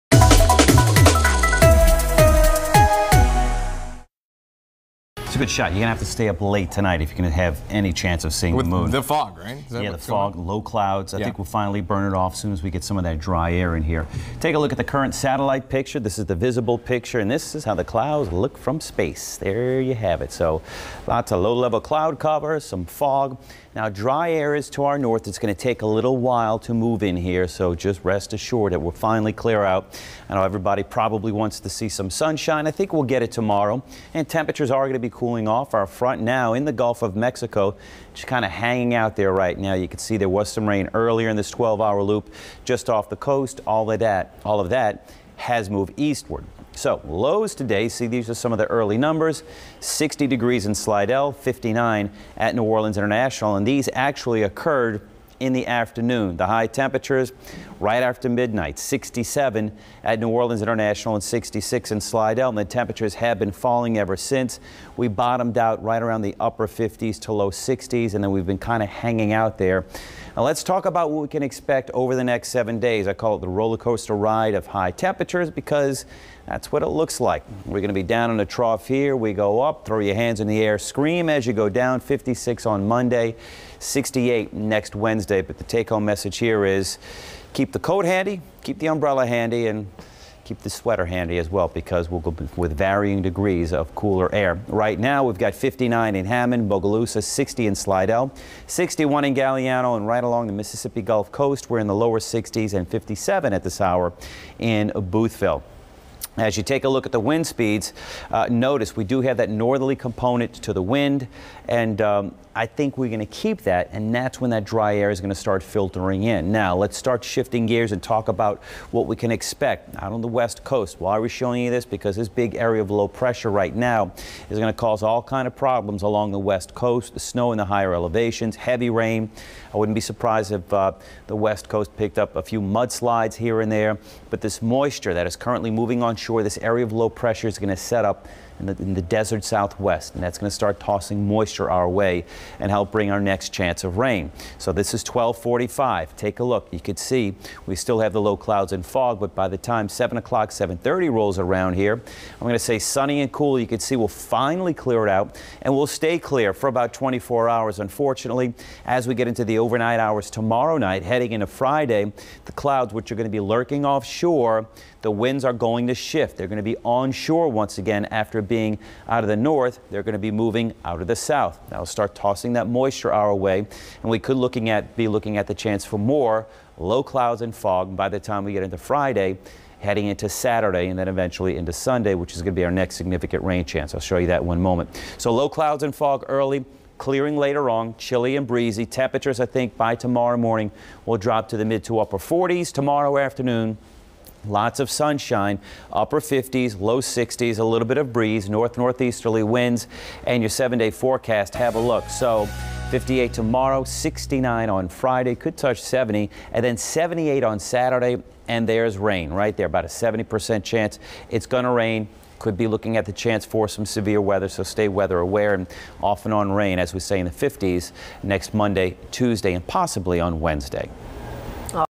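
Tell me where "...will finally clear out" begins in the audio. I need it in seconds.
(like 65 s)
28 s.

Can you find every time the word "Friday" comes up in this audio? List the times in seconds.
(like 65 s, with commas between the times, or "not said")
161 s, 178 s, 204 s.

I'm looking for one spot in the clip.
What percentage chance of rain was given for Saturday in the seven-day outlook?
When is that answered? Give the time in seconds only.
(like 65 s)
209 s.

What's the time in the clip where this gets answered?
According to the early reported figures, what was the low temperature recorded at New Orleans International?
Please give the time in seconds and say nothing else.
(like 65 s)
51 s.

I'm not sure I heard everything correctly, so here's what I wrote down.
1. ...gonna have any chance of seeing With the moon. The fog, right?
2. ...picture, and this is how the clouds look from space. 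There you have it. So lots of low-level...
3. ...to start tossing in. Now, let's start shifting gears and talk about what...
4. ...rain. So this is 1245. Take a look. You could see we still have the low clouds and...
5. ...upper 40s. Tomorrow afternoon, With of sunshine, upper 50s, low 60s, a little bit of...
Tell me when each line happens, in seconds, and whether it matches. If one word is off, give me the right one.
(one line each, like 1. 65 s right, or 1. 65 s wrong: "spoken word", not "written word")
1. 7 s right
2. 16 s right
3. 115 s wrong: "filtering", not "tossing"
4. 143 s right
5. 191 s wrong: "Lots", not "With".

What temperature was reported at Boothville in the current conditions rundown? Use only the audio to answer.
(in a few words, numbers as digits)
57.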